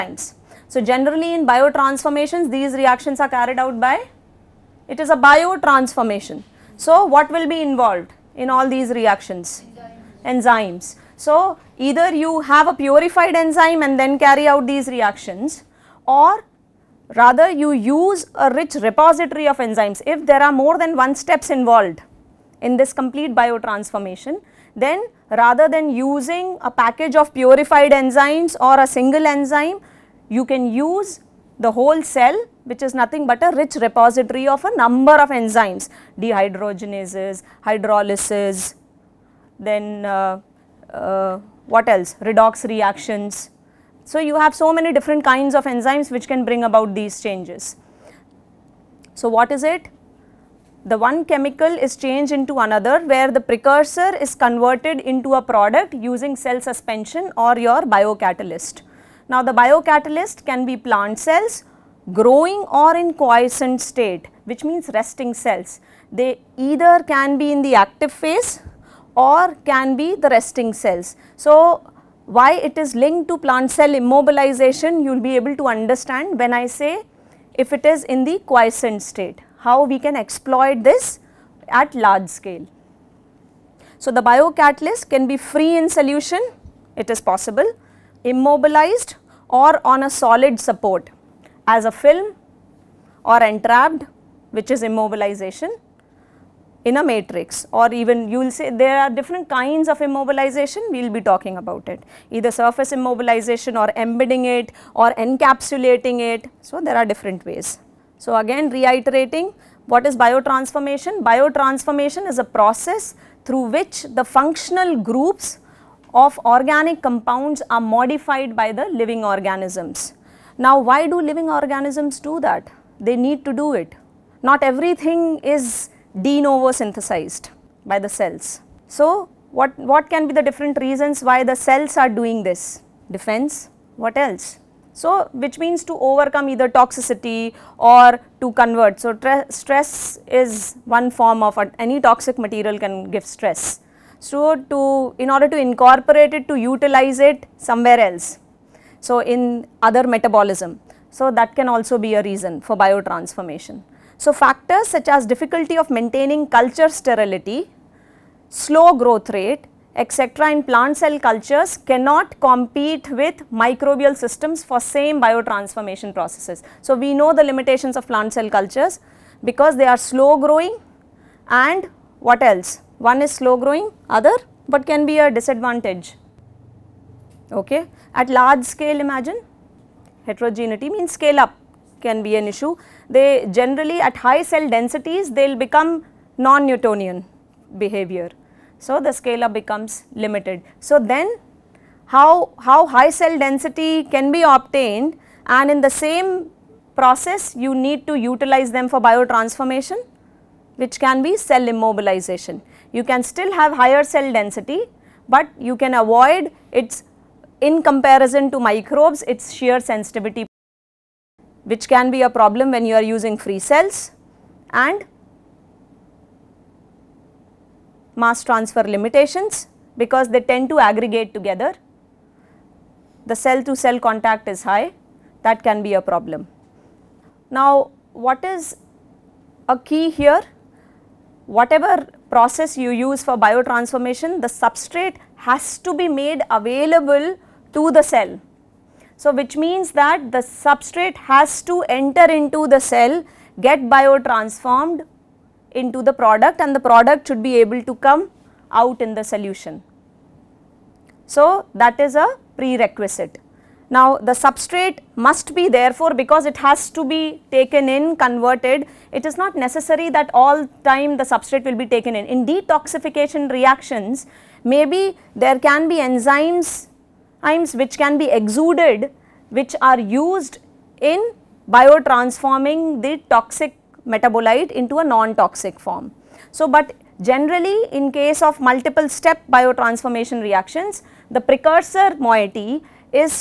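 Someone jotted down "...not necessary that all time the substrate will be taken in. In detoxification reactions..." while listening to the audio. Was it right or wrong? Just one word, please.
right.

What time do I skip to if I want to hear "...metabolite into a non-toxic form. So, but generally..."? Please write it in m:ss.
4:34.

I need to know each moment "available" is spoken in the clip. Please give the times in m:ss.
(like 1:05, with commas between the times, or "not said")
3:56.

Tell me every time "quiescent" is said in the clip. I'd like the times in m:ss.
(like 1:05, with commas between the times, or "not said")
1:03, 1:18.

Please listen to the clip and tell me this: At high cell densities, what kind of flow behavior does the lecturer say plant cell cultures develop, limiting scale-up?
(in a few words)
Non-Newtonian behavior.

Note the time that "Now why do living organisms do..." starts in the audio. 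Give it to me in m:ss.
2:00.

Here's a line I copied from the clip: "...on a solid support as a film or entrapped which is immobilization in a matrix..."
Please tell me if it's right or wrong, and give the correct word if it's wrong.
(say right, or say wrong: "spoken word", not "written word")
right.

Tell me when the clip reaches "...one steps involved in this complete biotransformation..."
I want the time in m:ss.
0:20.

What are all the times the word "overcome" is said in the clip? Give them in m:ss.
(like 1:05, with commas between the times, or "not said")
2:15.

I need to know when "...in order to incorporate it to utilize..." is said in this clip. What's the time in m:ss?
2:25.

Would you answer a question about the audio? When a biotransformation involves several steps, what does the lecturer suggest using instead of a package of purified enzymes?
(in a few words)
The whole cell.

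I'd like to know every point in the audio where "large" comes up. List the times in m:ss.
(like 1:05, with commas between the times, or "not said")
1:21, 2:58.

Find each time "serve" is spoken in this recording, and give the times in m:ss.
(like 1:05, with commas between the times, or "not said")
not said.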